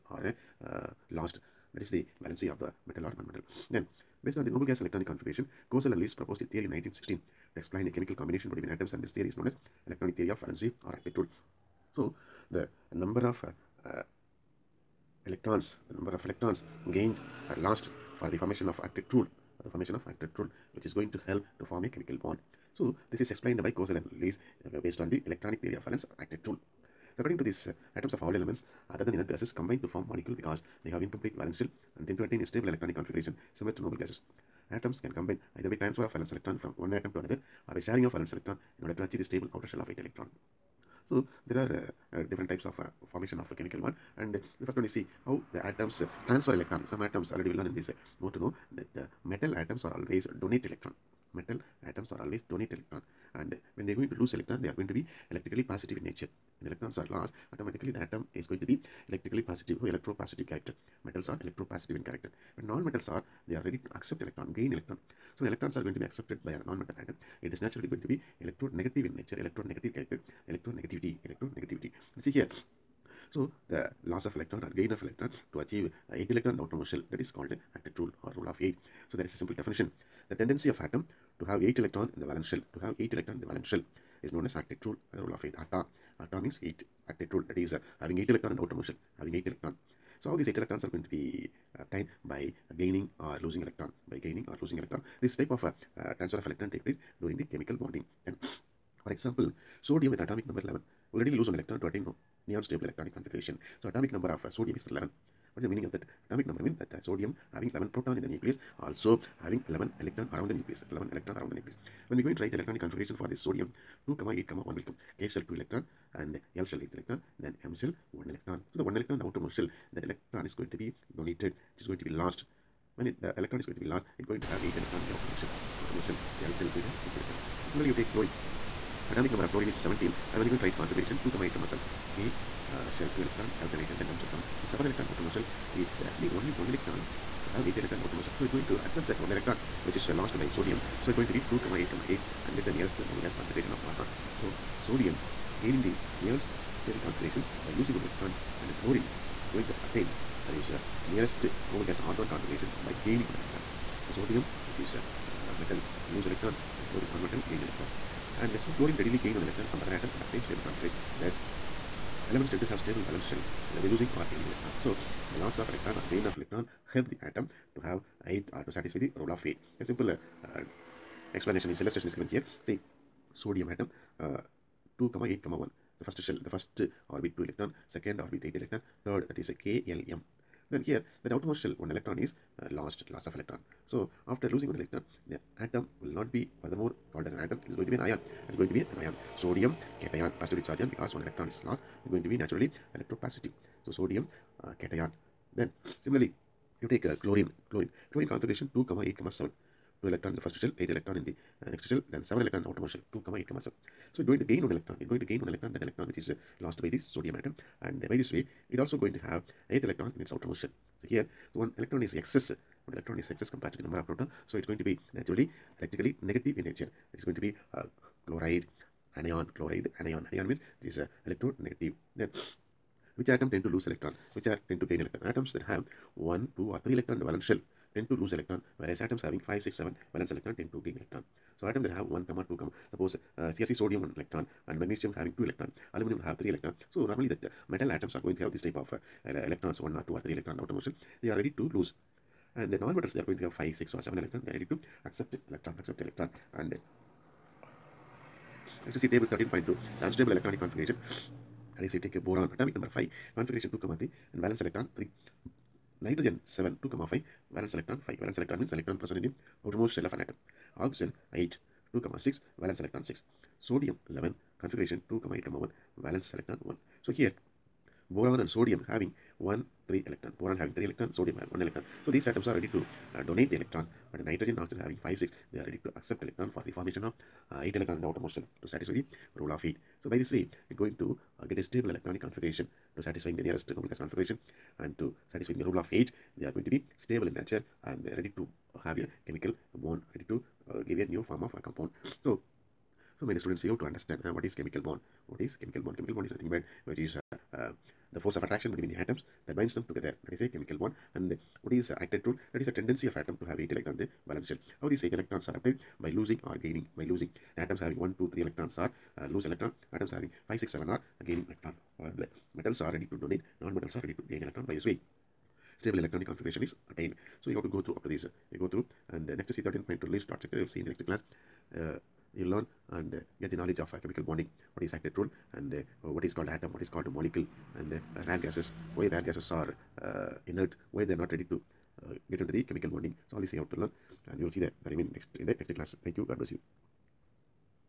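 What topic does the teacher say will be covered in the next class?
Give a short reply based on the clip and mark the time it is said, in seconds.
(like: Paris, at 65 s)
Lewis dot structure, at 320 s.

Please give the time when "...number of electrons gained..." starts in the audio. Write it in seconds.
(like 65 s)
15 s.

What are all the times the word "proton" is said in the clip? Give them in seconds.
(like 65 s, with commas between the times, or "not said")
107 s, 214 s.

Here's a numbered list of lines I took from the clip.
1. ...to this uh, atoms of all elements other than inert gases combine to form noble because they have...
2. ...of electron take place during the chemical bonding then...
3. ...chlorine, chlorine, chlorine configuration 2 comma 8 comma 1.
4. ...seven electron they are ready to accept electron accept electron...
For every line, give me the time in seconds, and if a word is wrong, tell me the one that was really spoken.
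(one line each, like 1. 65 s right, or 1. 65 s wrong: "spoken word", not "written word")
1. 27 s wrong: "molecule", not "noble"
2. 96 s right
3. 197 s wrong: "7", not "1"
4. 244 s right.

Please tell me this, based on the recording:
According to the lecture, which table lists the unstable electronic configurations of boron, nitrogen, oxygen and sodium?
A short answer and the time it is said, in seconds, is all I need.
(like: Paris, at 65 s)
Table 13.2, at 249 s.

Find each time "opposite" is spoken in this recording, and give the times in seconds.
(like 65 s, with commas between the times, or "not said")
not said.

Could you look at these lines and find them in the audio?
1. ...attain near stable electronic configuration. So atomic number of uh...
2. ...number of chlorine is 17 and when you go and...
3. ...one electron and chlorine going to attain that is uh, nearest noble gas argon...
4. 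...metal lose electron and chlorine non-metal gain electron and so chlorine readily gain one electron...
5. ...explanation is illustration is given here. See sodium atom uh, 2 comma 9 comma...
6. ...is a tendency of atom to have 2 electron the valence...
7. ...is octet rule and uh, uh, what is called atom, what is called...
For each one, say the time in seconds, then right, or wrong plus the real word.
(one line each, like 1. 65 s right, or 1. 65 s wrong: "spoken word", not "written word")
1. 101 s right
2. 129 s right
3. 147 s right
4. 155 s right
5. 171 s wrong: "8", not "9"
6. 302 s wrong: "8", not "2"
7. 324 s right.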